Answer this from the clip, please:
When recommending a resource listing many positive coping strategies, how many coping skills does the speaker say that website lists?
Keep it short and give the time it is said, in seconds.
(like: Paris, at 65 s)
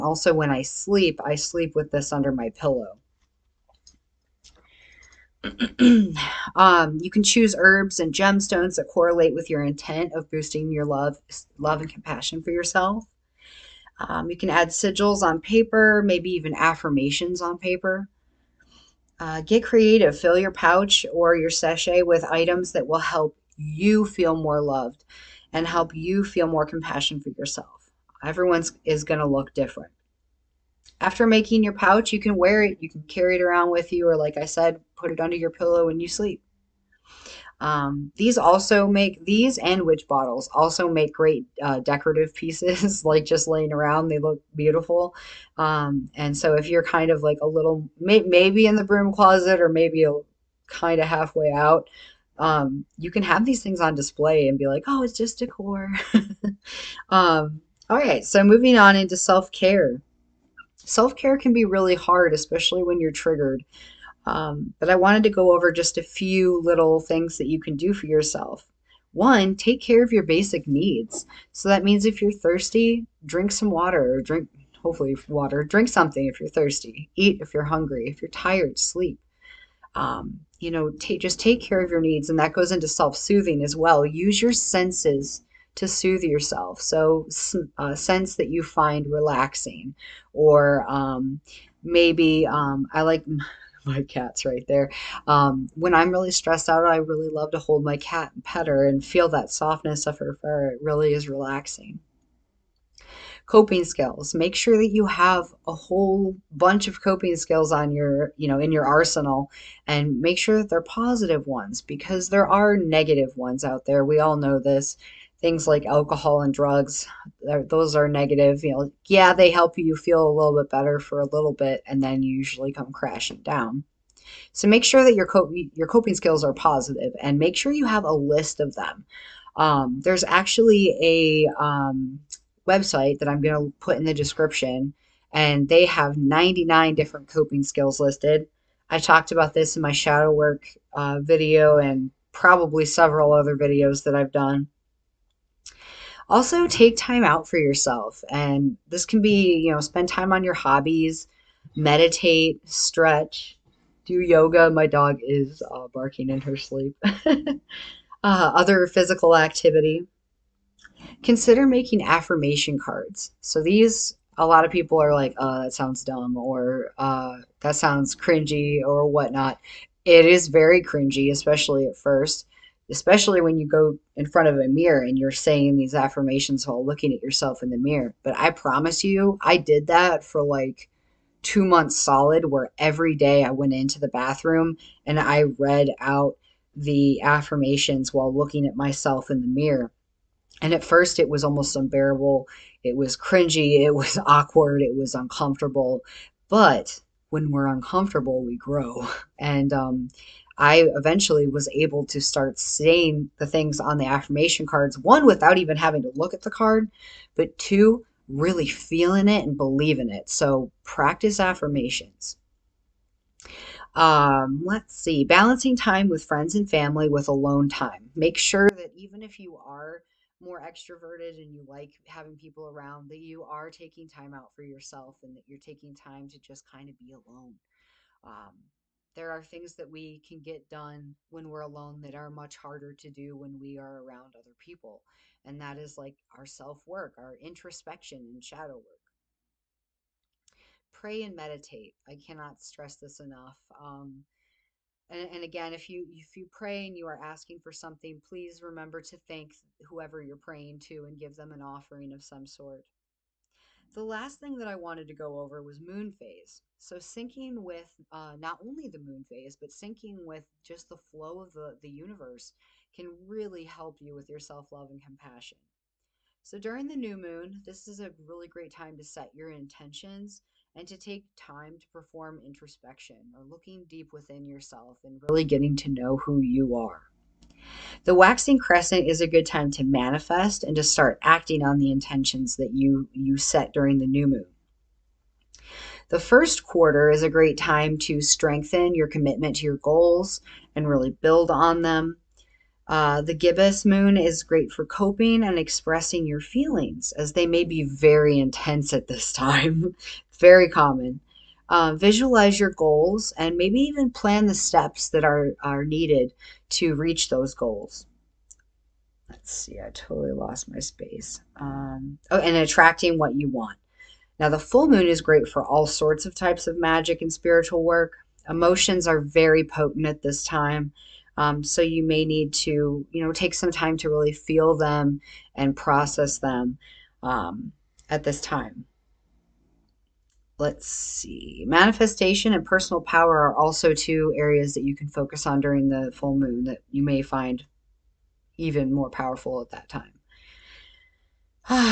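99, at 136 s.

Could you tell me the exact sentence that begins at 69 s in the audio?
One, take care of your basic needs.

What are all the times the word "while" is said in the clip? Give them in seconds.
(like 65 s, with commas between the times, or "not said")
176 s, 188 s.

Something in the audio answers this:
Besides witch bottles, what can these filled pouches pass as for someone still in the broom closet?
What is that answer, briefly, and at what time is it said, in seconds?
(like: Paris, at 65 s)
decor, at 55 s.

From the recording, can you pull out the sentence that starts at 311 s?
Um, oh, and attracting what you want.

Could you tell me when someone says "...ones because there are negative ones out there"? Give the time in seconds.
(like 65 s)
111 s.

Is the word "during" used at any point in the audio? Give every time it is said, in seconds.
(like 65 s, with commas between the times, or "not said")
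266 s, 283 s, 335 s.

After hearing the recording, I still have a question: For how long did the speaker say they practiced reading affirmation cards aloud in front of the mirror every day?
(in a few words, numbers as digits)
two months.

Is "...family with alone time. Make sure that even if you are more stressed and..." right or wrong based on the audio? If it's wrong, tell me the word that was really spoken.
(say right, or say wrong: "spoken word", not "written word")
wrong: "extroverted", not "stressed".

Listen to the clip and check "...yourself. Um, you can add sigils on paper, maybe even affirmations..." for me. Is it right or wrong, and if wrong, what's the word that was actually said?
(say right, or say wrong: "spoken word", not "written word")
right.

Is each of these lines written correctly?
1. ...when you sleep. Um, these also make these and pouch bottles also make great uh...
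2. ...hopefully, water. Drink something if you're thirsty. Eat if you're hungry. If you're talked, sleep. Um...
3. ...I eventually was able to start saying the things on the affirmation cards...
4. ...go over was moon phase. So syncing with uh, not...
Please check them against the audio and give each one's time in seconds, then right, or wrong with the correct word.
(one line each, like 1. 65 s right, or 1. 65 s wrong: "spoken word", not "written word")
1. 35 s wrong: "witch", not "pouch"
2. 74 s wrong: "tired", not "talked"
3. 200 s right
4. 255 s right.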